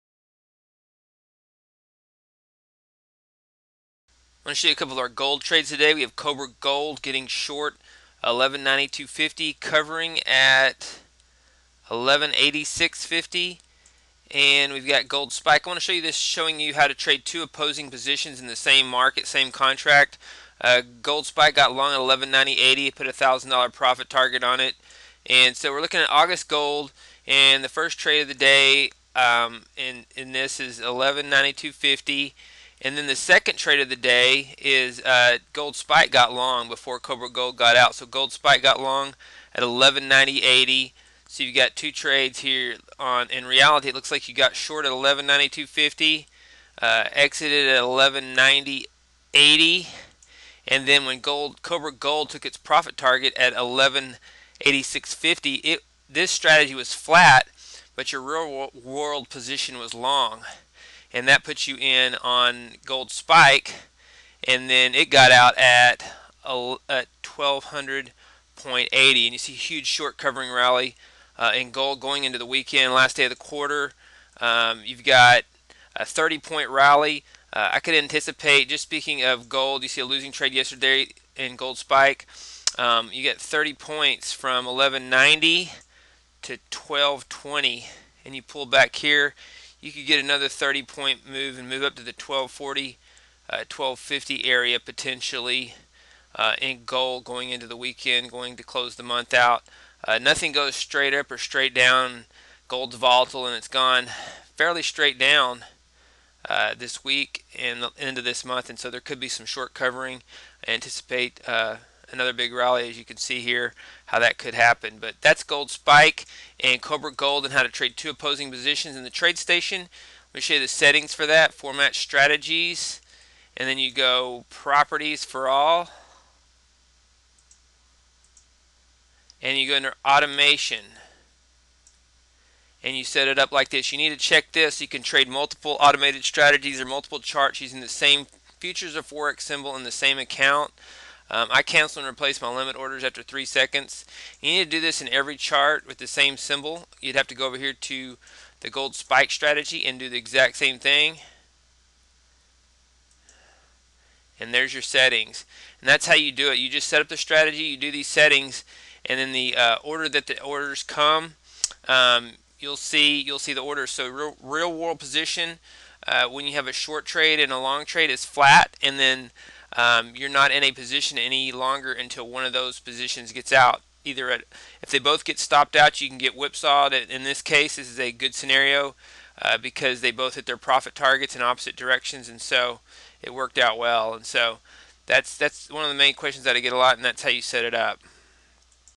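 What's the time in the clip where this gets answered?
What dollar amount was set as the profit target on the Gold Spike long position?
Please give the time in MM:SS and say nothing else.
00:23.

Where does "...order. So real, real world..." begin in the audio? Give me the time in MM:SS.
02:43.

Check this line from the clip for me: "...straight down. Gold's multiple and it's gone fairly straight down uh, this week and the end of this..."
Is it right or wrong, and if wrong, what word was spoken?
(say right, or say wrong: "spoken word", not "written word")
wrong: "volatile", not "multiple".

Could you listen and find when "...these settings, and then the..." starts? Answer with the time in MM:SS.
02:37.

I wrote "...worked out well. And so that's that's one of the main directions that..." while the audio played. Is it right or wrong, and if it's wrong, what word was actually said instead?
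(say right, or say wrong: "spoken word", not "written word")
wrong: "questions", not "directions".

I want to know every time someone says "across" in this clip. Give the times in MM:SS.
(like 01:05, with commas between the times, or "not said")
not said.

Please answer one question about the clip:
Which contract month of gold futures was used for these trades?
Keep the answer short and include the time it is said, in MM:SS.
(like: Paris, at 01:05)
August, at 00:26.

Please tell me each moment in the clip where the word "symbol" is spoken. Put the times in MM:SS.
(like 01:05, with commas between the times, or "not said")
02:19, 02:26.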